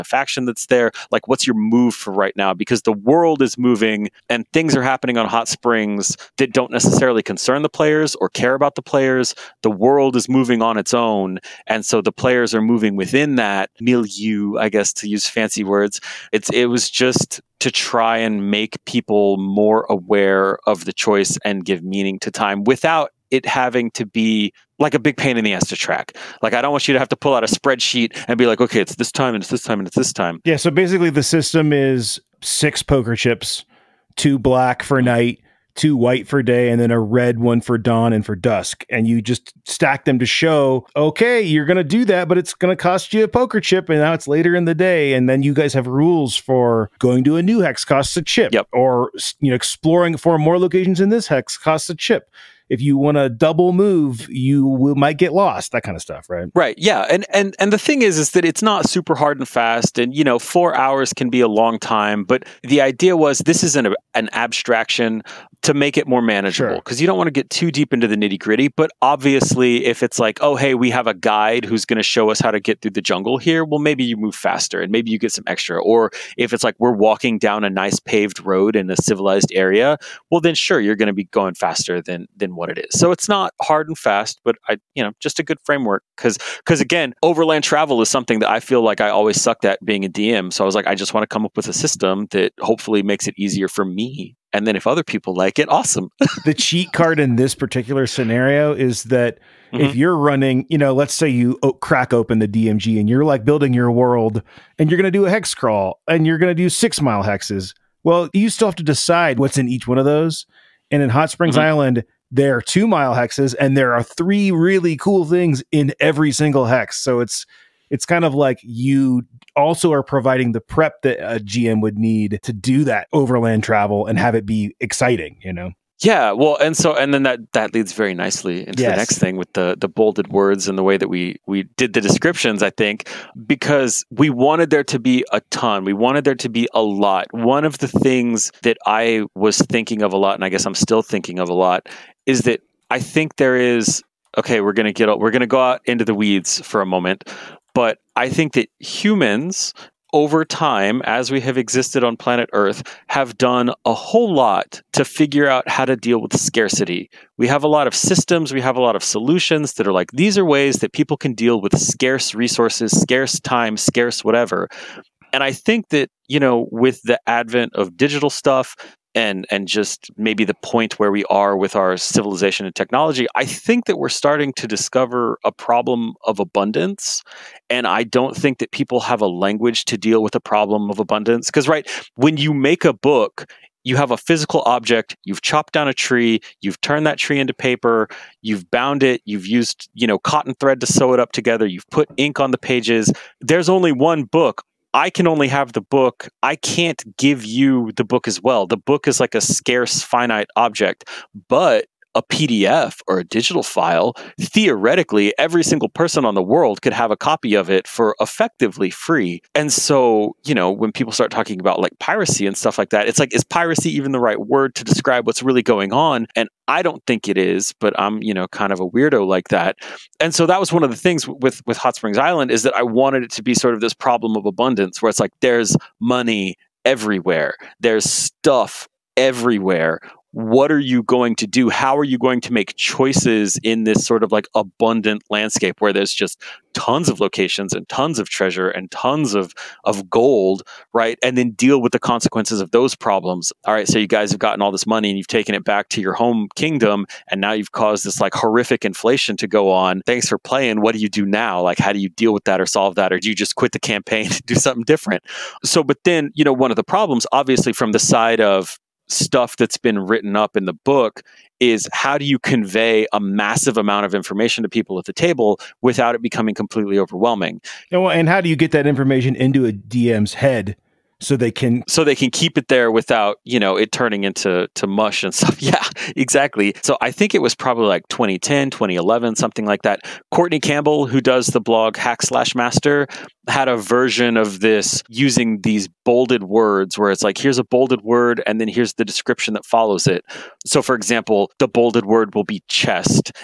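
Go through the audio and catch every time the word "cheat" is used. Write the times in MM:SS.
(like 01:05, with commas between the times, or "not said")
01:36.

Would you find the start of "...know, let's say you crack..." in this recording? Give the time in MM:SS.
01:40.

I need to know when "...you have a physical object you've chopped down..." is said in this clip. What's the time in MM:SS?
03:03.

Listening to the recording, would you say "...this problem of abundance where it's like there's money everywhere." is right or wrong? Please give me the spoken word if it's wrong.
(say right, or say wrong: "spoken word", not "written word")
right.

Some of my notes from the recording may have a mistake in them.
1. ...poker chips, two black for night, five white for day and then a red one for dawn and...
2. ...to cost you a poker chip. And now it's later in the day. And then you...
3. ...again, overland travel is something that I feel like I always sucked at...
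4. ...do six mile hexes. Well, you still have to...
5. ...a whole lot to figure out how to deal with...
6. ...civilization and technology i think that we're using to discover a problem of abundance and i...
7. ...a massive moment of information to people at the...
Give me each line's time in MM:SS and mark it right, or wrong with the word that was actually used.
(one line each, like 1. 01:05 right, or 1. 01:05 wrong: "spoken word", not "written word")
1. 00:32 wrong: "two", not "five"
2. 00:42 right
3. 01:26 right
4. 01:46 right
5. 02:33 right
6. 02:51 wrong: "starting", not "using"
7. 04:23 wrong: "amount", not "moment".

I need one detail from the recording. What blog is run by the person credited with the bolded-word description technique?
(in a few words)
Hack Slash Master.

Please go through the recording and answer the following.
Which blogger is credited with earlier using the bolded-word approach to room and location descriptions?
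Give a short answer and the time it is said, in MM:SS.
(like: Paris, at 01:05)
Courtney Campbell, at 04:40.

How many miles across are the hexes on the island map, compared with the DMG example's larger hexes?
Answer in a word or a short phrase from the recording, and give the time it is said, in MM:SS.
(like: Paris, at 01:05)
2 miles, at 01:52.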